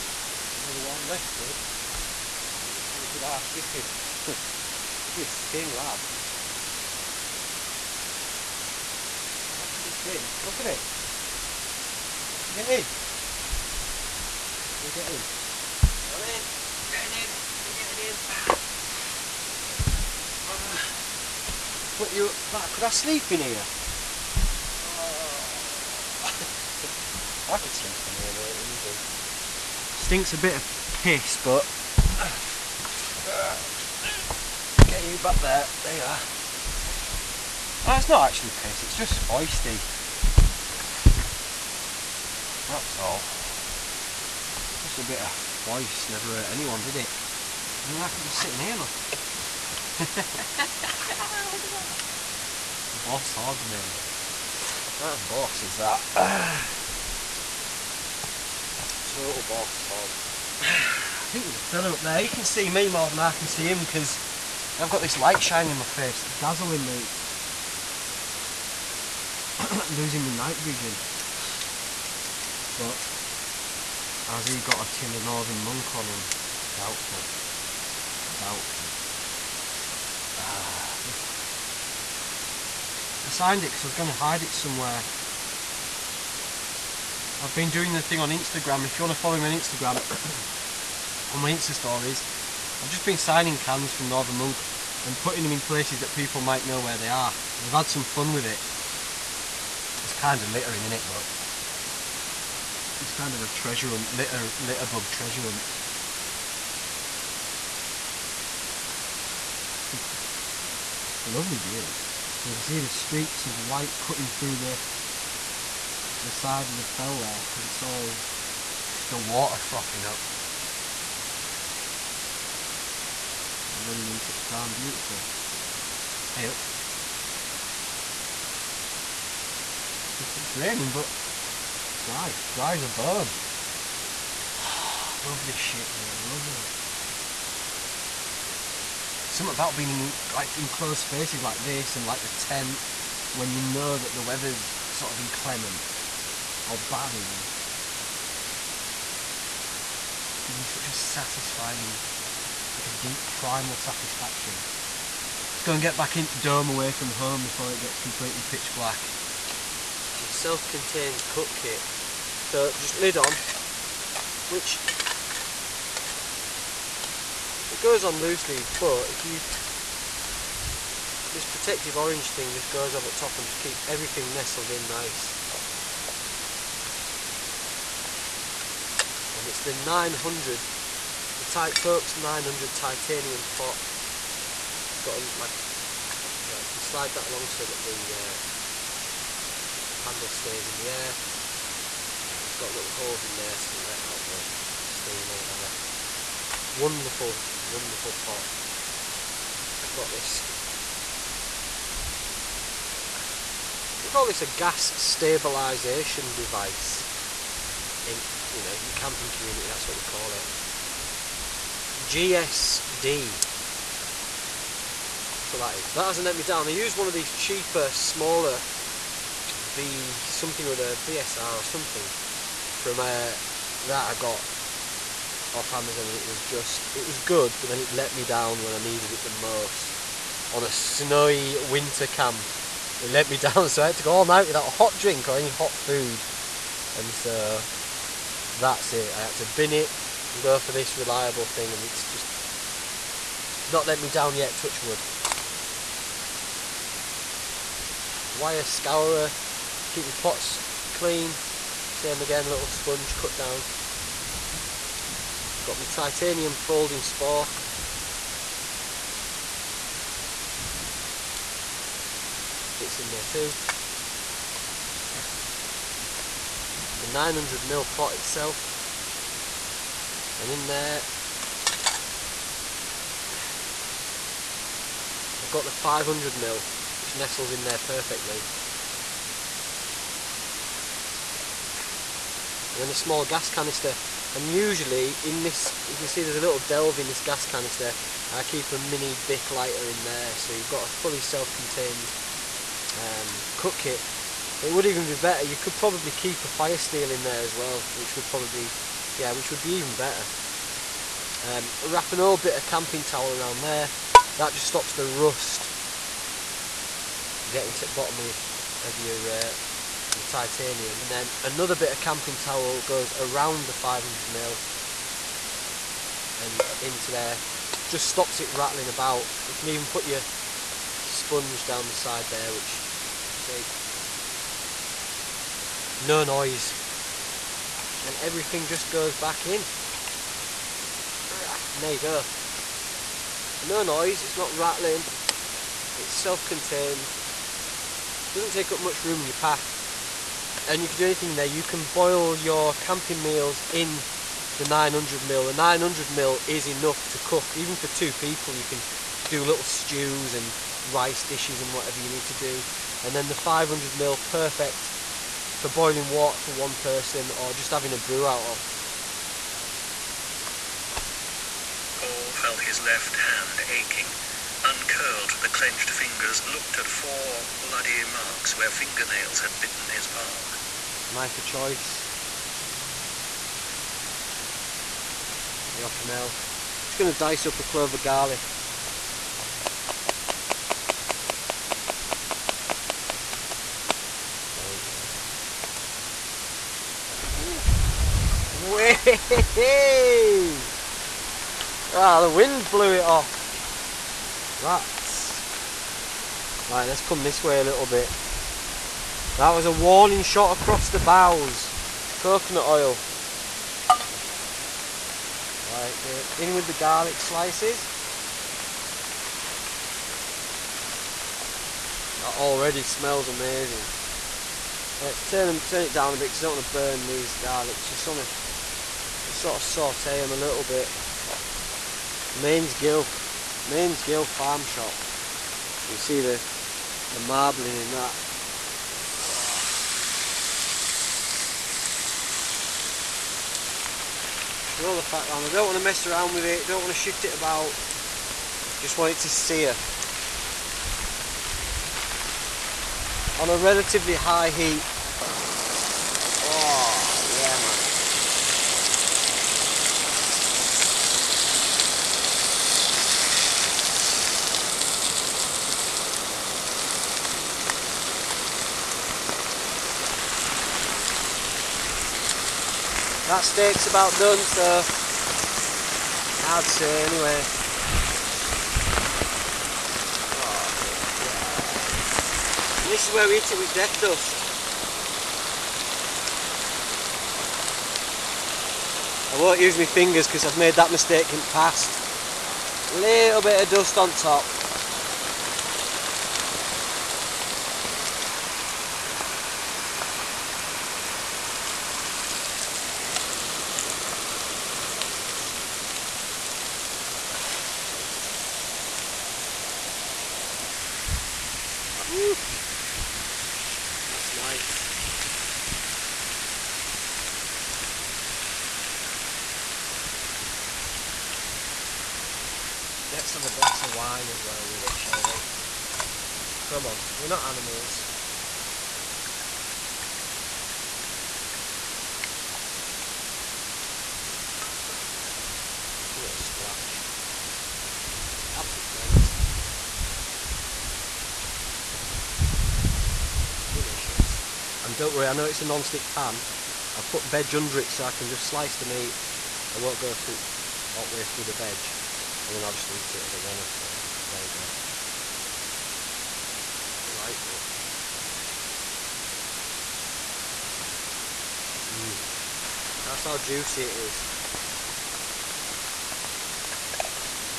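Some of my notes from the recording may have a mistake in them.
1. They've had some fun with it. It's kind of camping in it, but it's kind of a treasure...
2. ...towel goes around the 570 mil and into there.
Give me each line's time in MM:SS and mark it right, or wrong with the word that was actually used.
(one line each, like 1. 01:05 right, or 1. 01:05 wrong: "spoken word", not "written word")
1. 01:37 wrong: "littering", not "camping"
2. 05:12 wrong: "500", not "570".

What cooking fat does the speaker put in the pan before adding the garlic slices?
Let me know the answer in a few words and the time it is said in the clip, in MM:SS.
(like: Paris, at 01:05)
Coconut oil, at 06:42.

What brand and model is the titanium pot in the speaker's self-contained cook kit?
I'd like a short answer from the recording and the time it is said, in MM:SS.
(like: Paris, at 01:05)
Titox 900, at 03:01.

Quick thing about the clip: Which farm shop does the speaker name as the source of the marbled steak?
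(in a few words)
Mainsgill Farm Shop.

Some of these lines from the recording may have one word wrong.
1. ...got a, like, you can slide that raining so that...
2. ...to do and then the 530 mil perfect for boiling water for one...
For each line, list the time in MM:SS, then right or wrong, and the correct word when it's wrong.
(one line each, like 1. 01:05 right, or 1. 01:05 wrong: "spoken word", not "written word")
1. 03:05 wrong: "along", not "raining"
2. 05:52 wrong: "500", not "530".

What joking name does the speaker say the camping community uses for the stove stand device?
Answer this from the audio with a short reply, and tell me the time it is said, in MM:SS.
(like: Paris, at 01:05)
gas stabilization device, at 03:24.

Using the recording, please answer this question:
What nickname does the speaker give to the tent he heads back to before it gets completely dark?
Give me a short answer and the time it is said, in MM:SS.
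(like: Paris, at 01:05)
dome away from home, at 02:36.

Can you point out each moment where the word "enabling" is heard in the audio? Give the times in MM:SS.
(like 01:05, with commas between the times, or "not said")
not said.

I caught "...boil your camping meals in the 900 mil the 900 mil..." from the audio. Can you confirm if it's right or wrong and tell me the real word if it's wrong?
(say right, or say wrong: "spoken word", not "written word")
right.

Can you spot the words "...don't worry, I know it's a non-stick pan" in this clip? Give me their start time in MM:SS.
08:54.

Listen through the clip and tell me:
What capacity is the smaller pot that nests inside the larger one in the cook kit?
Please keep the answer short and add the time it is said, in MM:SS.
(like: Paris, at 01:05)
500ml, at 04:35.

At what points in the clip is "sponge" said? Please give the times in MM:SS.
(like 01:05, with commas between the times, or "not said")
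04:12, 05:21.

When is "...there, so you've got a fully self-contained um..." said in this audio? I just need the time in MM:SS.
04:50.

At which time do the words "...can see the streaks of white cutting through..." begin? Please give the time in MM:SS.
01:52.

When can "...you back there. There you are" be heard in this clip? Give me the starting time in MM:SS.
00:35.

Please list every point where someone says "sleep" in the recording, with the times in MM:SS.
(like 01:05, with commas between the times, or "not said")
00:22, 00:27.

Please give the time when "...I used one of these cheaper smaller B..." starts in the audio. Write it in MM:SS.
03:36.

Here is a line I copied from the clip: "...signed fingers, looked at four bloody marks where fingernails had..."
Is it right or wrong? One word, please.
wrong.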